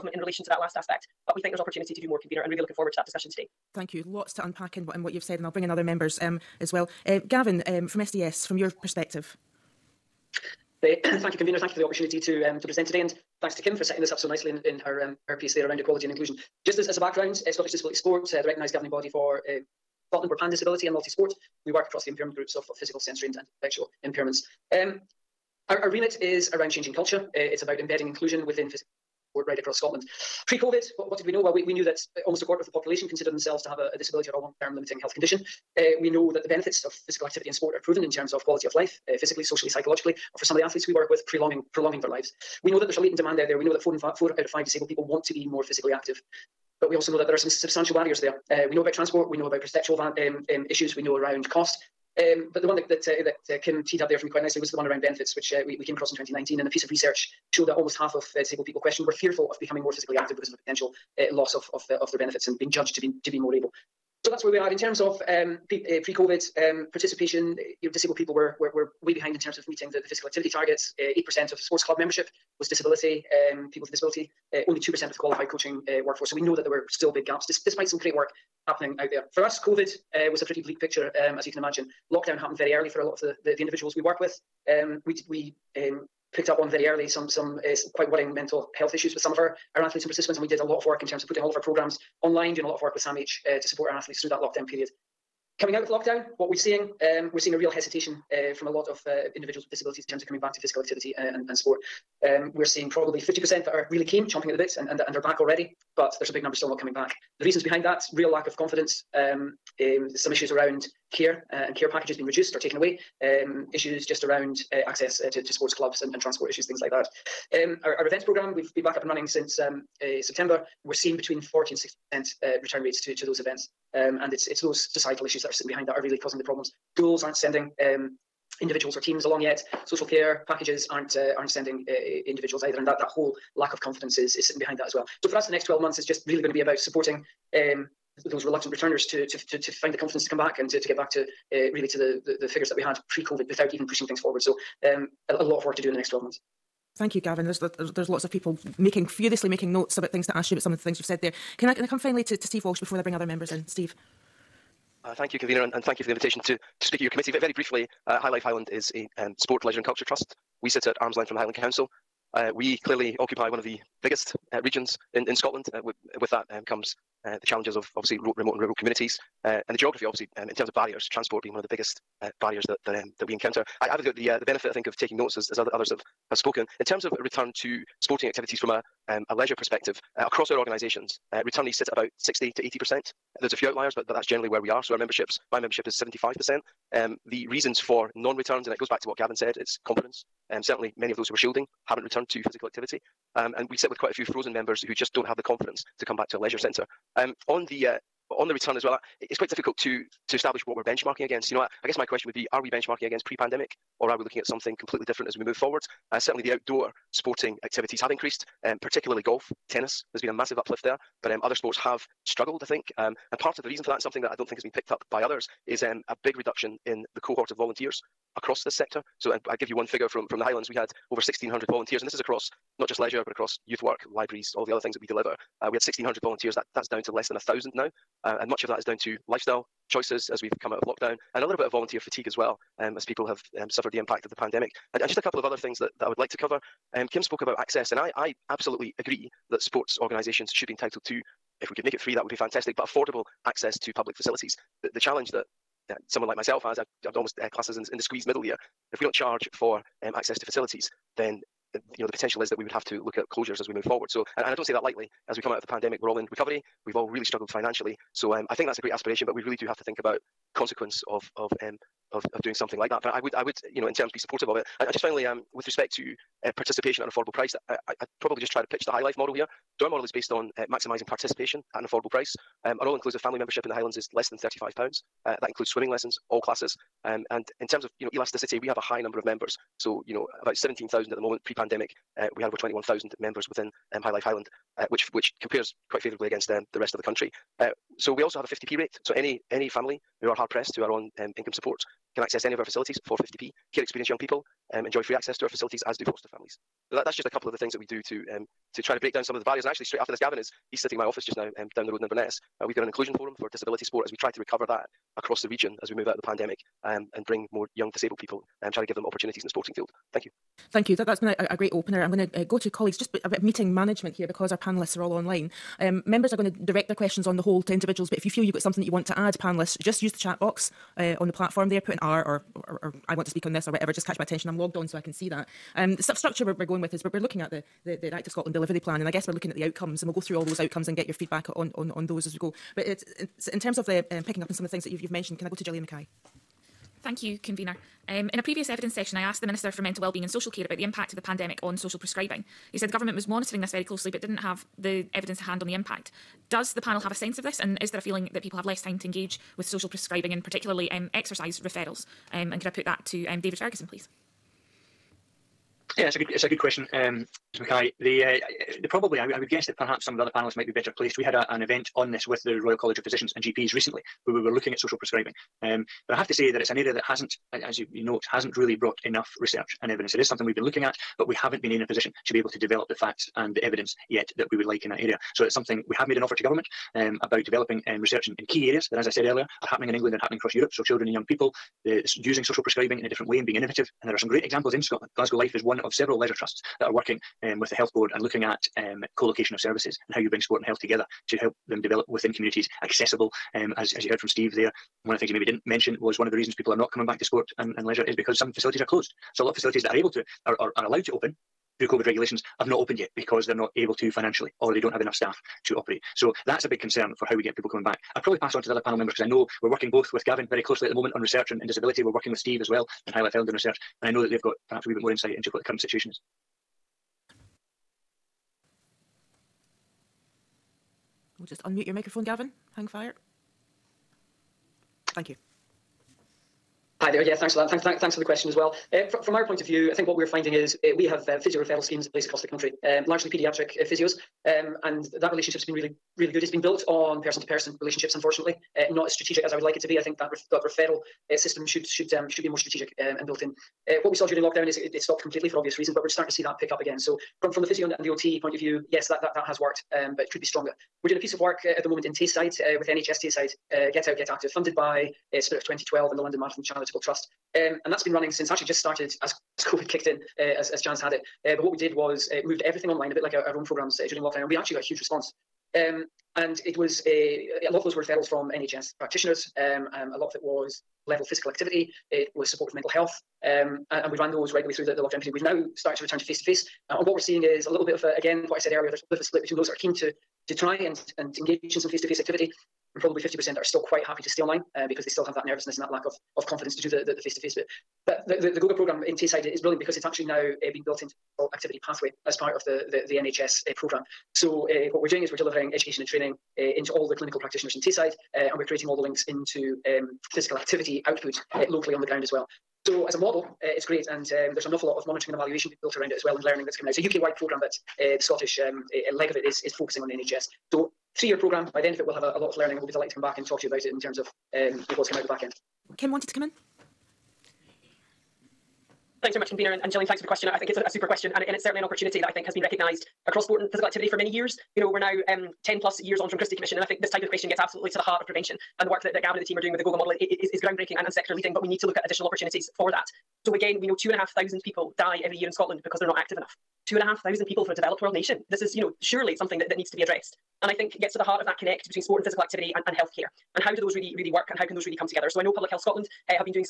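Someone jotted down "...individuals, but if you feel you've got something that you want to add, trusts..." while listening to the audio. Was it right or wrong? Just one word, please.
wrong.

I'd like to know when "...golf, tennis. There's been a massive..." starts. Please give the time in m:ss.
3:29.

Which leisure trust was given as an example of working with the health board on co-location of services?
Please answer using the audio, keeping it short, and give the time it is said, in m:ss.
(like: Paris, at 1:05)
Glasgow Life, at 6:25.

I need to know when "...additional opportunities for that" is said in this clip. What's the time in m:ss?
8:52.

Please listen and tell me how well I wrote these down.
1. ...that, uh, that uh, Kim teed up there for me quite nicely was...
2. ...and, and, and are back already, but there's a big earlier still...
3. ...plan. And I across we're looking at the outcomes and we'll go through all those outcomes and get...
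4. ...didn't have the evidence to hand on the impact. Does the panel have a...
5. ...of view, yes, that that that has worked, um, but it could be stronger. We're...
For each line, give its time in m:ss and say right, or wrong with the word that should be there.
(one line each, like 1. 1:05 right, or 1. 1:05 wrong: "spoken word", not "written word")
1. 0:52 right
2. 1:44 wrong: "number", not "earlier"
3. 5:28 wrong: "guess", not "across"
4. 5:44 right
5. 7:28 right.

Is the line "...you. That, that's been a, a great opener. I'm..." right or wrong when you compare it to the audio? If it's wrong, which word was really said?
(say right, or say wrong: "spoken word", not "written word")
right.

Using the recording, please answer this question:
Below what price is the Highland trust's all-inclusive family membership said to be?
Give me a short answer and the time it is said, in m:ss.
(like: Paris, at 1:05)
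£35, at 4:34.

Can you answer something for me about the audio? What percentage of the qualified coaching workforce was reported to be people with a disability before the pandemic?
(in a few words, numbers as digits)
2%.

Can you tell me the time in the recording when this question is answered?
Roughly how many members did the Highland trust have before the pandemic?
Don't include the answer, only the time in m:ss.
4:42.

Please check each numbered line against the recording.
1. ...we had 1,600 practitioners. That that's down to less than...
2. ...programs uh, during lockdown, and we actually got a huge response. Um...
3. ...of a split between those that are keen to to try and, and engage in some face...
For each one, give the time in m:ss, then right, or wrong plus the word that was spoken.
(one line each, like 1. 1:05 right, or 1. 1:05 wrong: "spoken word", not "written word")
1. 3:45 wrong: "volunteers", not "practitioners"
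2. 7:43 right
3. 7:59 right.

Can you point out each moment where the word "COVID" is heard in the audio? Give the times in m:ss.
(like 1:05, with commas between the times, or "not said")
0:30, 1:06, 1:19, 2:23, 6:41, 7:39.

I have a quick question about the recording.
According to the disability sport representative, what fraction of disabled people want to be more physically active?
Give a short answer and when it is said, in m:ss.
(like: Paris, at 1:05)
4 out of 5, at 0:44.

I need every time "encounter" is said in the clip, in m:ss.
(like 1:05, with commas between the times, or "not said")
2:53.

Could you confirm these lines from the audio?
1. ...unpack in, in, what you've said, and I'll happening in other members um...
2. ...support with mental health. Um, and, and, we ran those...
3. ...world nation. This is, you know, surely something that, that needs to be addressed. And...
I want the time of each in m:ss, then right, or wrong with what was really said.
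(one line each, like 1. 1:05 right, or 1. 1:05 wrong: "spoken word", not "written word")
1. 0:04 wrong: "bring", not "happening"
2. 7:52 right
3. 8:58 right.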